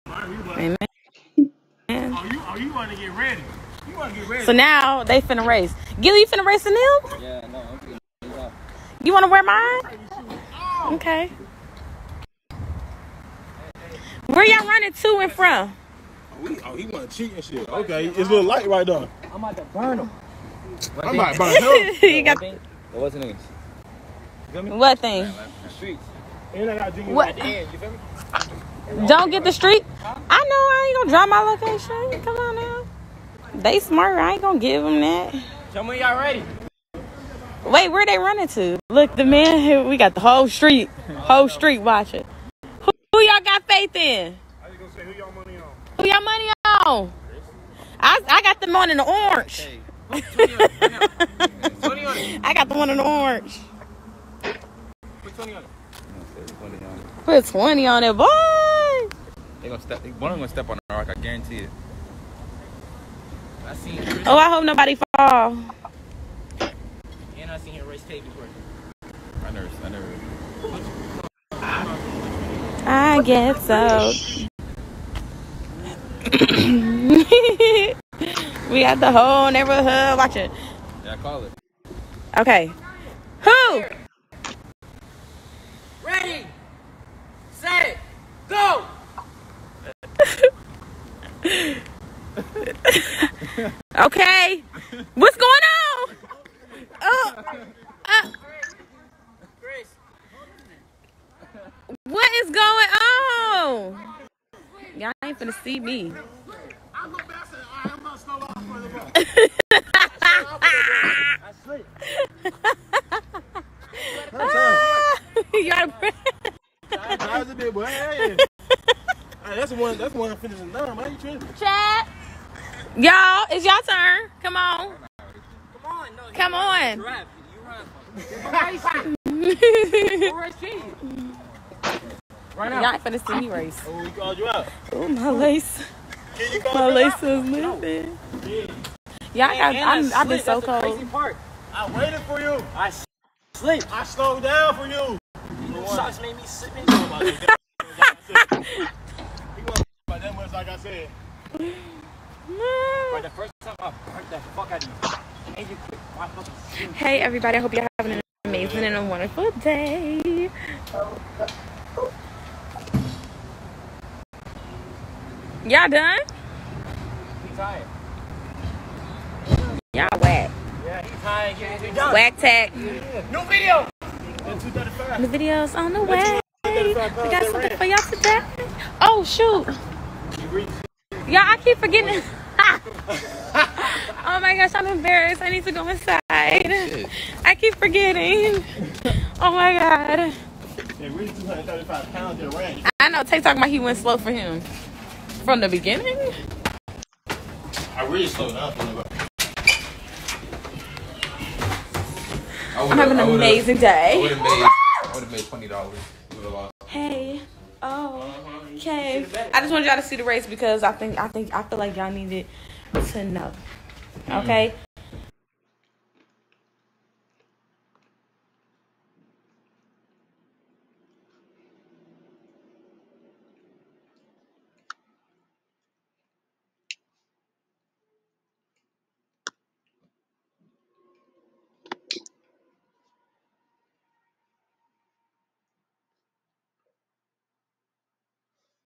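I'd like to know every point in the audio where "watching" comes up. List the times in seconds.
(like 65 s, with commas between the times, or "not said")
41 s, 80 s.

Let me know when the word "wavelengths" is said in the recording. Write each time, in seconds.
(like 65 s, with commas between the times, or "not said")
not said.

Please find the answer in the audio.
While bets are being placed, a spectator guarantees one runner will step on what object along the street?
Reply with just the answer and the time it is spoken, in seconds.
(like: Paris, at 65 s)
The rock, at 60 s.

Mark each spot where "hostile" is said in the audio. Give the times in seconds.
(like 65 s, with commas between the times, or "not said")
not said.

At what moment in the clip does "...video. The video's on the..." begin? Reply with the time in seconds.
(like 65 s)
173 s.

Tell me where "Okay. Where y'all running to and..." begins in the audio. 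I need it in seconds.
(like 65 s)
10 s.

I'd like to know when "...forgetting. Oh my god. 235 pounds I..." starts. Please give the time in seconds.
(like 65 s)
187 s.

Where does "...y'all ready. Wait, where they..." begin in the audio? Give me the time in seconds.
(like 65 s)
35 s.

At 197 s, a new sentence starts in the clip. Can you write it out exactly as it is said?
I really slowed down I'm having an amazing day.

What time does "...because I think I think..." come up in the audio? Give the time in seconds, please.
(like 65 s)
210 s.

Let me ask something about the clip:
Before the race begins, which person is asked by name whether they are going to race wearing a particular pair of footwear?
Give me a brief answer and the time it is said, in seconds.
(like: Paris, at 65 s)
Gilly, at 6 s.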